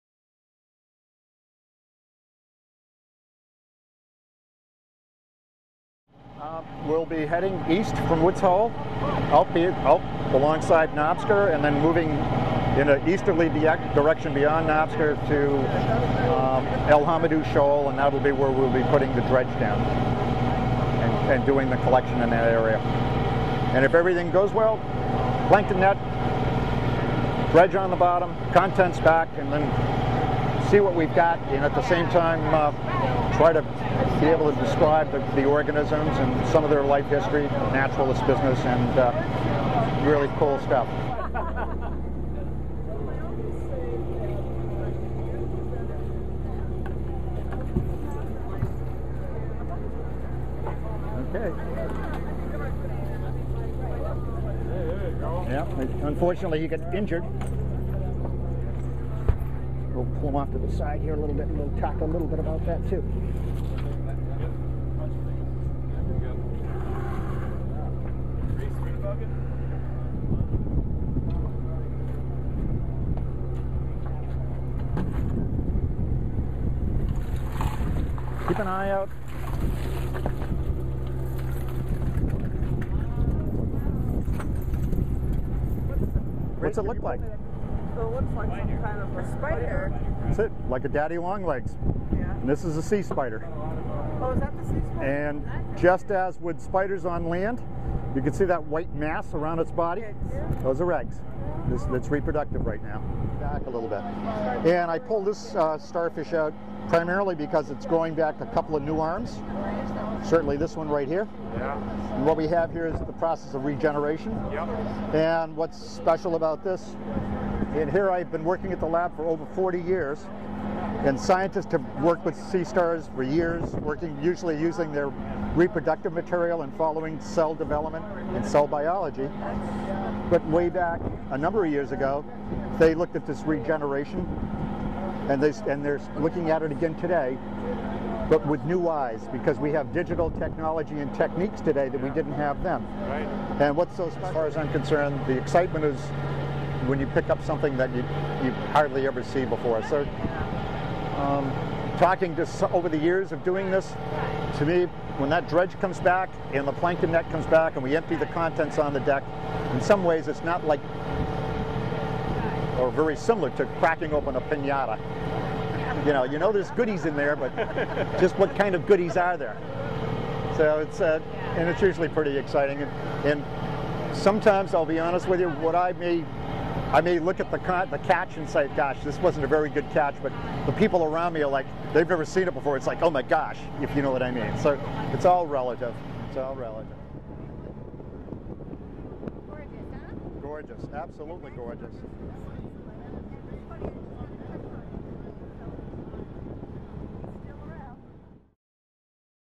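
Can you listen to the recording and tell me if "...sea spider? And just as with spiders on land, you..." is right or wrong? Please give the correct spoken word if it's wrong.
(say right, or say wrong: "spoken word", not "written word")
right.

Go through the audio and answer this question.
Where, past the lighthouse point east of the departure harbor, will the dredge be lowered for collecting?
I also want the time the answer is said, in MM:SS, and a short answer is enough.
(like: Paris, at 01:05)
L'Hommedieu Shoal, at 00:16.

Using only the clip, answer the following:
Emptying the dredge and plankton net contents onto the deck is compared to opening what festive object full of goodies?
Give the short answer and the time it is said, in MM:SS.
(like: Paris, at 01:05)
A pinata, at 02:44.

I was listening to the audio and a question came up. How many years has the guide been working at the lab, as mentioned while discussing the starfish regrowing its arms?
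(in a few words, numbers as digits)
40.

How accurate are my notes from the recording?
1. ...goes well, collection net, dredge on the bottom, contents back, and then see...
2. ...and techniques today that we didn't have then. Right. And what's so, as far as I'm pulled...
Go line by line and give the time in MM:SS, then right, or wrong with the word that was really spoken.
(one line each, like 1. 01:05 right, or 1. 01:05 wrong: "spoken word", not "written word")
1. 00:24 wrong: "plankton", not "collection"
2. 02:20 wrong: "concerned", not "pulled".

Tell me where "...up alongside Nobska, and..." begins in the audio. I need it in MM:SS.
00:09.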